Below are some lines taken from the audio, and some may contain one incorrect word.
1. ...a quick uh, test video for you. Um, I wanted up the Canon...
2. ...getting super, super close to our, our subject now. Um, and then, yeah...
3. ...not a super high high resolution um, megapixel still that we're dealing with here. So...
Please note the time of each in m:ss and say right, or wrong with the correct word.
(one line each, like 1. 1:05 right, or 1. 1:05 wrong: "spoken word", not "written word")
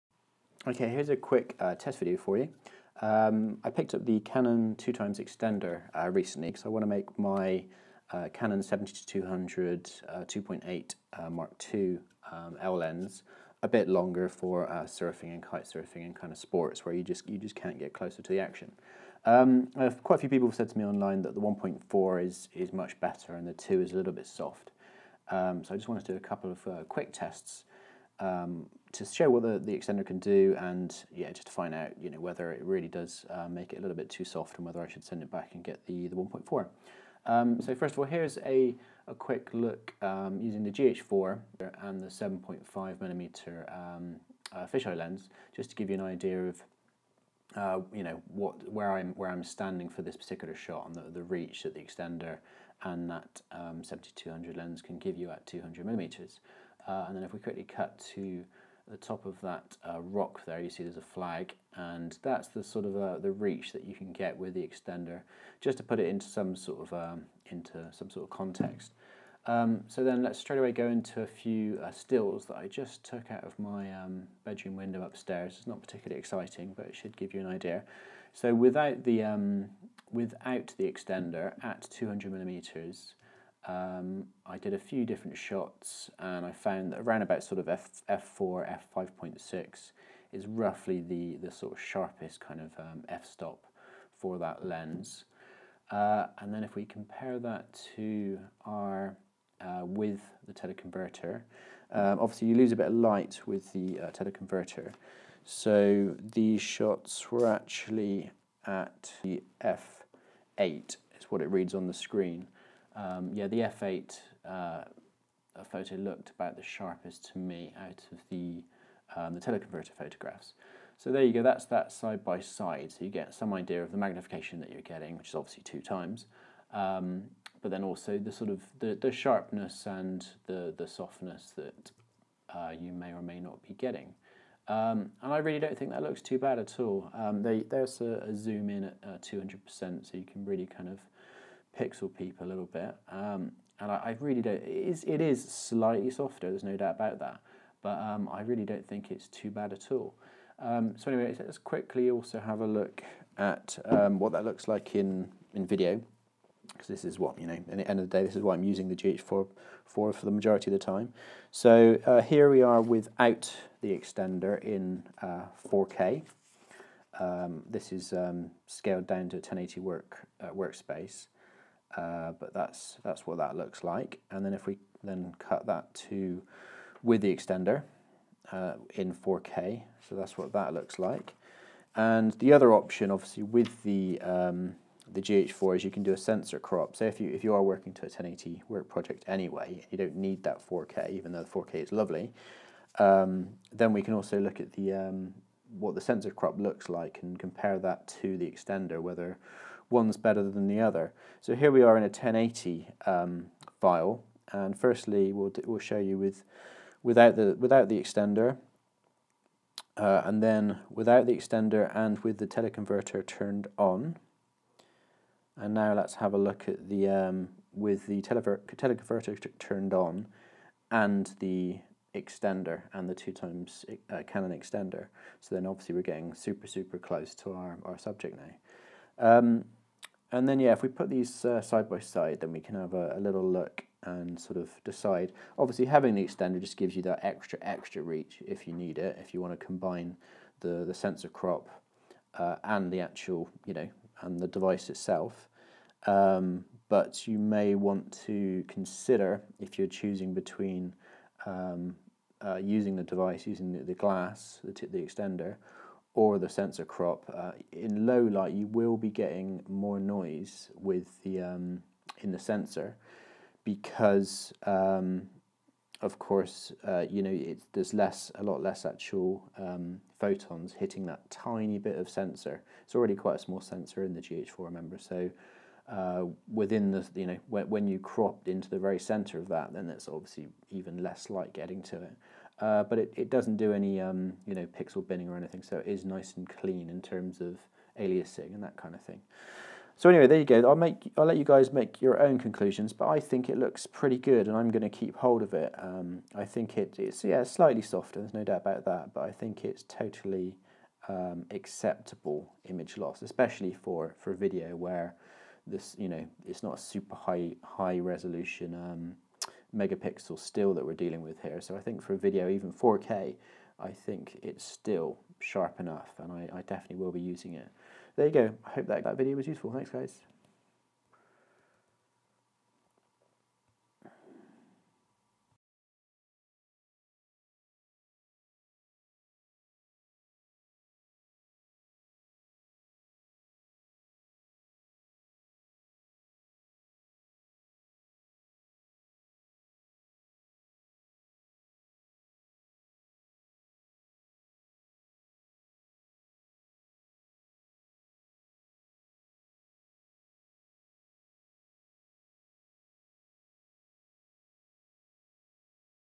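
1. 0:01 wrong: "picked", not "wanted"
2. 3:46 right
3. 5:06 right.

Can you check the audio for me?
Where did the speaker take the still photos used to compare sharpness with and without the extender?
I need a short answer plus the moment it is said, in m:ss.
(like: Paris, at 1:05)
Bedroom window upstairs, at 1:14.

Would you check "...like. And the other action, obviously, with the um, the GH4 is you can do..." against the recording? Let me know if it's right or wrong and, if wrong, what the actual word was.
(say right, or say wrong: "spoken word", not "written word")
wrong: "option", not "action".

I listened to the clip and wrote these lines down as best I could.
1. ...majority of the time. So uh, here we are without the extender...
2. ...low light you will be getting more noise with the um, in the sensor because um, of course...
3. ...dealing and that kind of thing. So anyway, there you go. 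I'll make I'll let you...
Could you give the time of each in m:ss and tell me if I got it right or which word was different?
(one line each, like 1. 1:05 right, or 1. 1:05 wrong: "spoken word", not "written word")
1. 2:40 right
2. 4:18 right
3. 4:47 wrong: "aliasing", not "dealing".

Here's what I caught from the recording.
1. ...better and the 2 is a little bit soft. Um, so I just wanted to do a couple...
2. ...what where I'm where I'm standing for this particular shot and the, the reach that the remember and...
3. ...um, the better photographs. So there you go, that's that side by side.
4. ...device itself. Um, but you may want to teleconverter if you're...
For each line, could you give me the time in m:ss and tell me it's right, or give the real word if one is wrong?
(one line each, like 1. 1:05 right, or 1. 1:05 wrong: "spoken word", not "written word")
1. 0:22 right
2. 0:48 wrong: "extender", not "remember"
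3. 1:59 wrong: "teleconverter", not "better"
4. 4:04 wrong: "consider", not "teleconverter".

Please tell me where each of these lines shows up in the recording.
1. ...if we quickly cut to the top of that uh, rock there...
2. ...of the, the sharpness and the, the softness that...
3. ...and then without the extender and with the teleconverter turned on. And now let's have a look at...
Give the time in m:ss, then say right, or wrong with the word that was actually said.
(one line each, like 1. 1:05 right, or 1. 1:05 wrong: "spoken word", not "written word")
1. 0:57 right
2. 2:08 right
3. 3:30 right.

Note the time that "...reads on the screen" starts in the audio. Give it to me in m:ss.
1:51.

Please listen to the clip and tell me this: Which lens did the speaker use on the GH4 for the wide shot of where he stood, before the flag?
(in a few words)
7.5mm fisheye.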